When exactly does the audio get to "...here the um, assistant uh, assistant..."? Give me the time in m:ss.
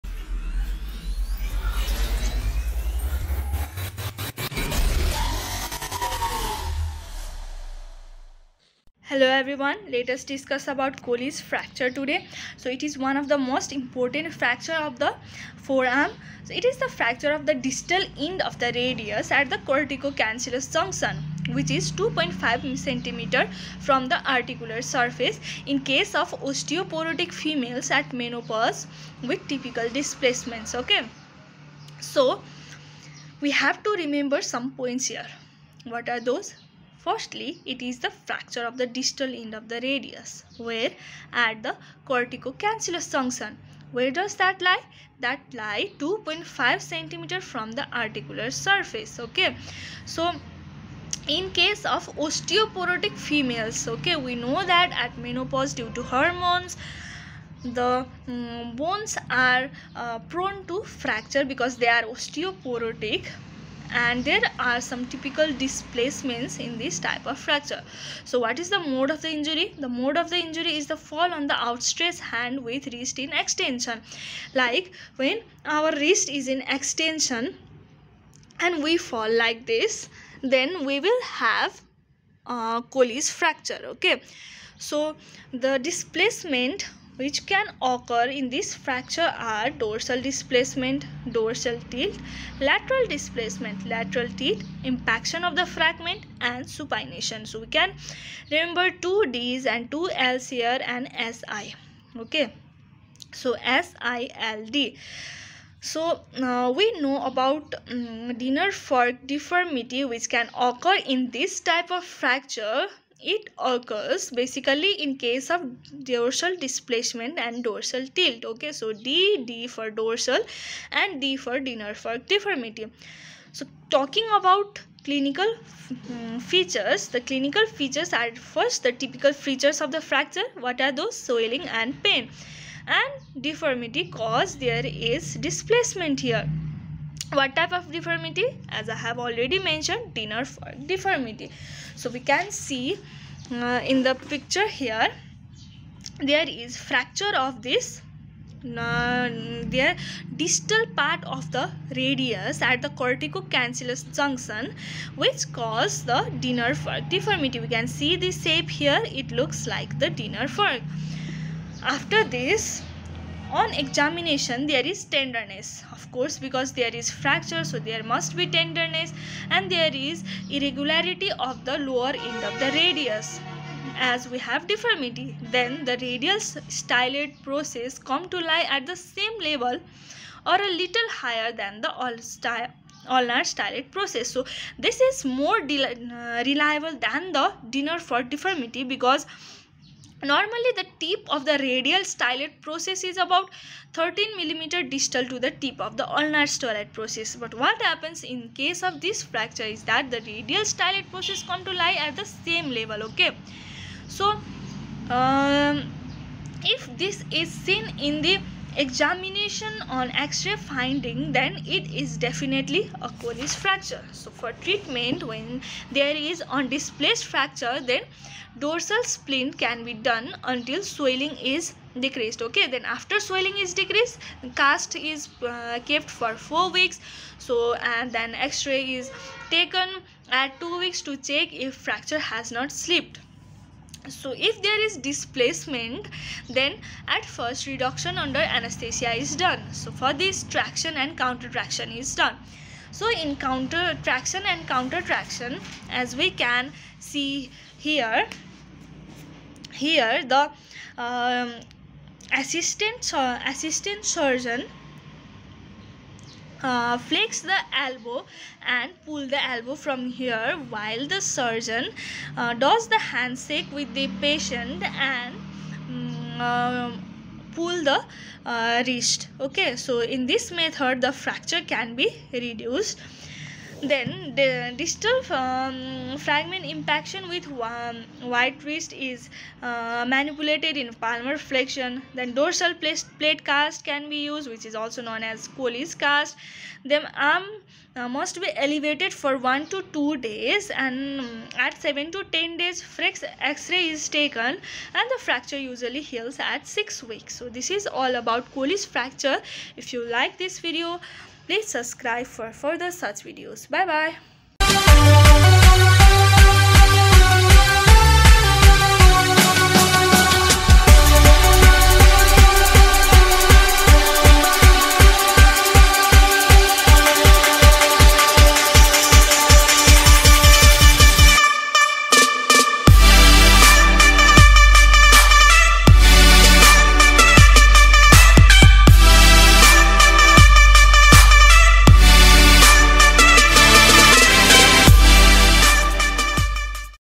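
4:09.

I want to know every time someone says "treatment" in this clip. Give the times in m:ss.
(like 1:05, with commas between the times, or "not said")
3:34.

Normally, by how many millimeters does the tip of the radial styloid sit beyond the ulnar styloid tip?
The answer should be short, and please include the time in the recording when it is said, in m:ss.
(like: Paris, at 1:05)
13, at 3:13.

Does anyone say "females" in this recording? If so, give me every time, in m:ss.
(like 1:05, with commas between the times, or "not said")
0:27, 0:53.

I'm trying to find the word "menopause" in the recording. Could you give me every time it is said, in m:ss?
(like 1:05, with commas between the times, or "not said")
0:28, 0:55.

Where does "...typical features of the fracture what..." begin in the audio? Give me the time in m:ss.
2:08.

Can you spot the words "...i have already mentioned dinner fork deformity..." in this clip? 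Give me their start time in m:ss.
2:18.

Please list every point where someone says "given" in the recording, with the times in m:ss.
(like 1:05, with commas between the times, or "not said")
not said.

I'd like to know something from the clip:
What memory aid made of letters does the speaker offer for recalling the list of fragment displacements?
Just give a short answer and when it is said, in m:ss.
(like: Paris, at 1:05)
SILD, at 1:43.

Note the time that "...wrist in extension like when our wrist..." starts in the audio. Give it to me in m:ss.
1:12.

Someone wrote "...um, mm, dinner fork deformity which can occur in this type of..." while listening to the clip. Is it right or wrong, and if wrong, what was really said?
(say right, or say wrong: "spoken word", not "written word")
right.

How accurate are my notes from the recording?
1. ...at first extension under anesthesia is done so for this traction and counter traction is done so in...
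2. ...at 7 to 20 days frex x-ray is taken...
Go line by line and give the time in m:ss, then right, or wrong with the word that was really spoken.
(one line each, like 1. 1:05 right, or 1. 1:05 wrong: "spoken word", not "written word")
1. 3:57 wrong: "reduction", not "extension"
2. 4:51 wrong: "10", not "20".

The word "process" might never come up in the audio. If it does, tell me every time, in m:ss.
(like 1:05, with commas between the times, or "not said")
2:57, 3:03, 3:12, 3:16, 3:21.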